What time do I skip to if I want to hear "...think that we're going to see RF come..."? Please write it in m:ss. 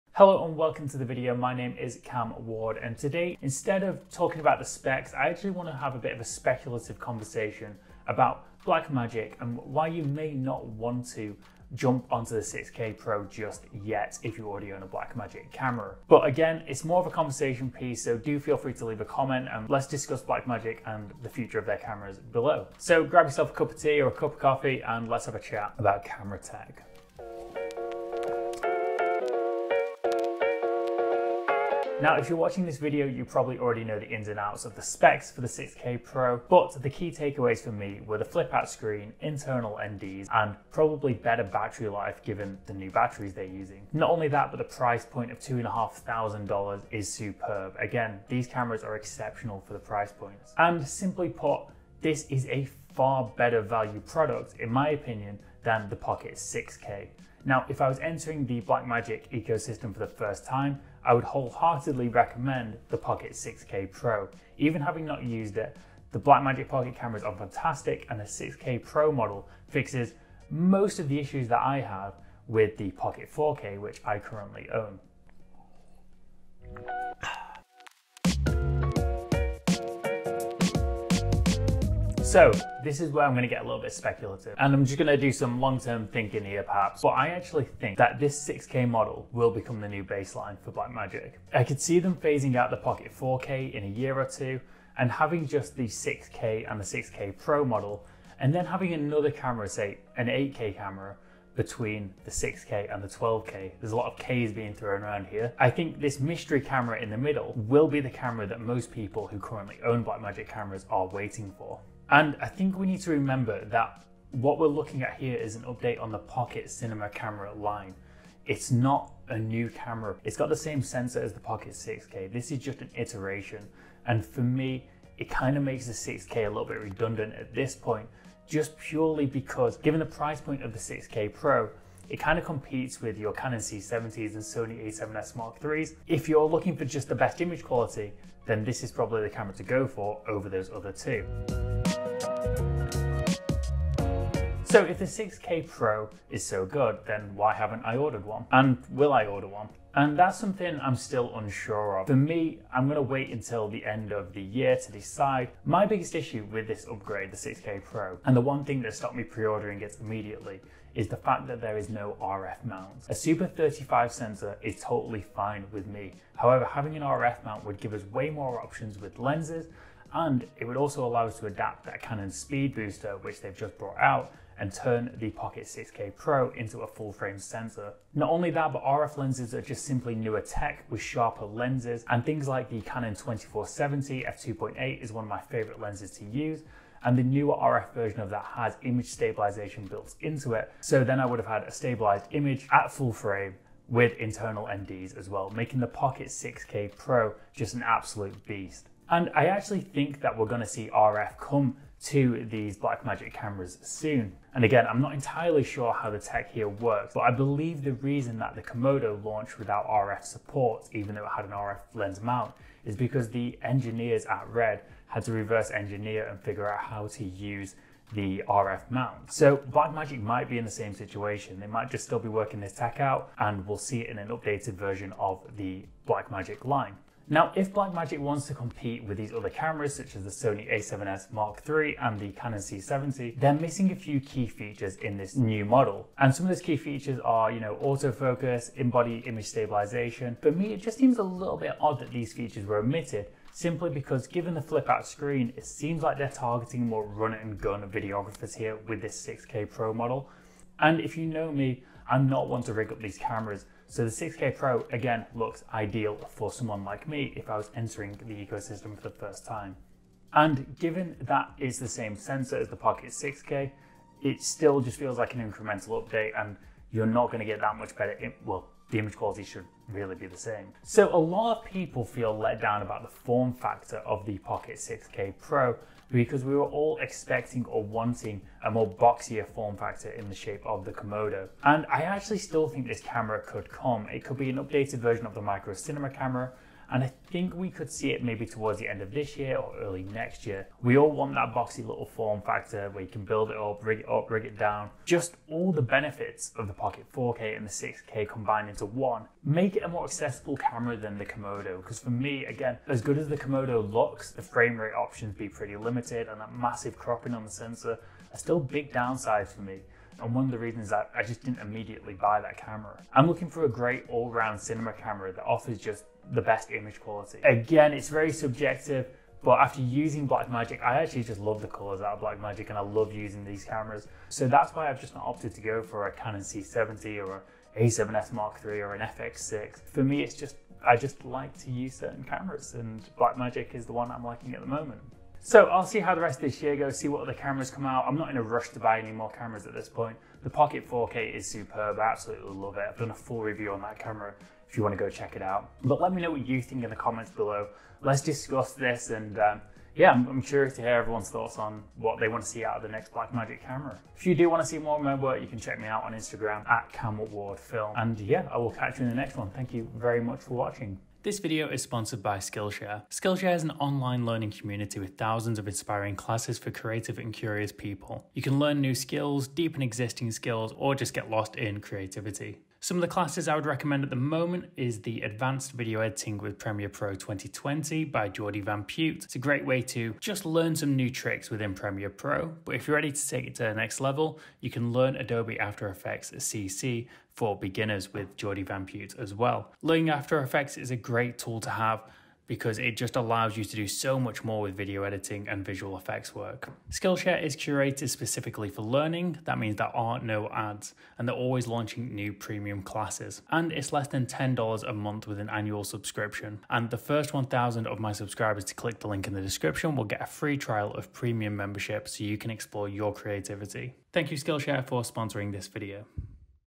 3:19.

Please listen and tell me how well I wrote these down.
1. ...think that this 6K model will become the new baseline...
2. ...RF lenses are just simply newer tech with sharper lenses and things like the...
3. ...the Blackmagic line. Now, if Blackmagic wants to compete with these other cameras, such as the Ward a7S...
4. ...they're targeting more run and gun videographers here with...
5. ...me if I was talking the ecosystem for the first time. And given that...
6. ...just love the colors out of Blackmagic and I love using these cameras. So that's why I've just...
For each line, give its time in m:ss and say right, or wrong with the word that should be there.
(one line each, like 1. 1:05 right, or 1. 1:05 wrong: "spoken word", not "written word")
1. 1:27 right
2. 2:58 right
3. 3:45 wrong: "Sony", not "Ward"
4. 4:06 right
5. 4:17 wrong: "entering", not "talking"
6. 5:21 right.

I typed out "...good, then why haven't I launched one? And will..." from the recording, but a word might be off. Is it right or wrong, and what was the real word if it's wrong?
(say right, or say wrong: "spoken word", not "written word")
wrong: "ordered", not "launched".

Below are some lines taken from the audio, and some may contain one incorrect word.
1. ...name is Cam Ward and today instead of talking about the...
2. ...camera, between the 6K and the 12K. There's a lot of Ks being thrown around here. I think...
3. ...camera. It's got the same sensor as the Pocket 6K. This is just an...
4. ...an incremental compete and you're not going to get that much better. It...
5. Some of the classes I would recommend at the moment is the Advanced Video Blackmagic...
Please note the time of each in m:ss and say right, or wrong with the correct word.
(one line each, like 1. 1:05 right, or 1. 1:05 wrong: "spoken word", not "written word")
1. 0:01 right
2. 1:40 right
3. 1:59 right
4. 4:25 wrong: "update", not "compete"
5. 6:12 wrong: "Editing", not "Blackmagic".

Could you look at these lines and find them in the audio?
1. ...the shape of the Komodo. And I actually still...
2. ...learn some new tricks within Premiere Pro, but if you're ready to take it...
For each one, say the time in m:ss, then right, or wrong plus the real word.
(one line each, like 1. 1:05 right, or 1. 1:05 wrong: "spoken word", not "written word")
1. 4:40 right
2. 6:20 right.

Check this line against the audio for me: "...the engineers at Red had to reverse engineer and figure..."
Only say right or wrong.
right.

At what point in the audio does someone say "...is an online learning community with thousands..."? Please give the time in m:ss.
6:03.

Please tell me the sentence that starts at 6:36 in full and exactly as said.
Skillshare is curated specifically for learning.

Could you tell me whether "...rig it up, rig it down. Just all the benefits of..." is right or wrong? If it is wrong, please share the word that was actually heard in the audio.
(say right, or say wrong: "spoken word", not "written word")
right.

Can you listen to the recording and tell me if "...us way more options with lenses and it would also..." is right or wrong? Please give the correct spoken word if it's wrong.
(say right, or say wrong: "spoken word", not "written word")
right.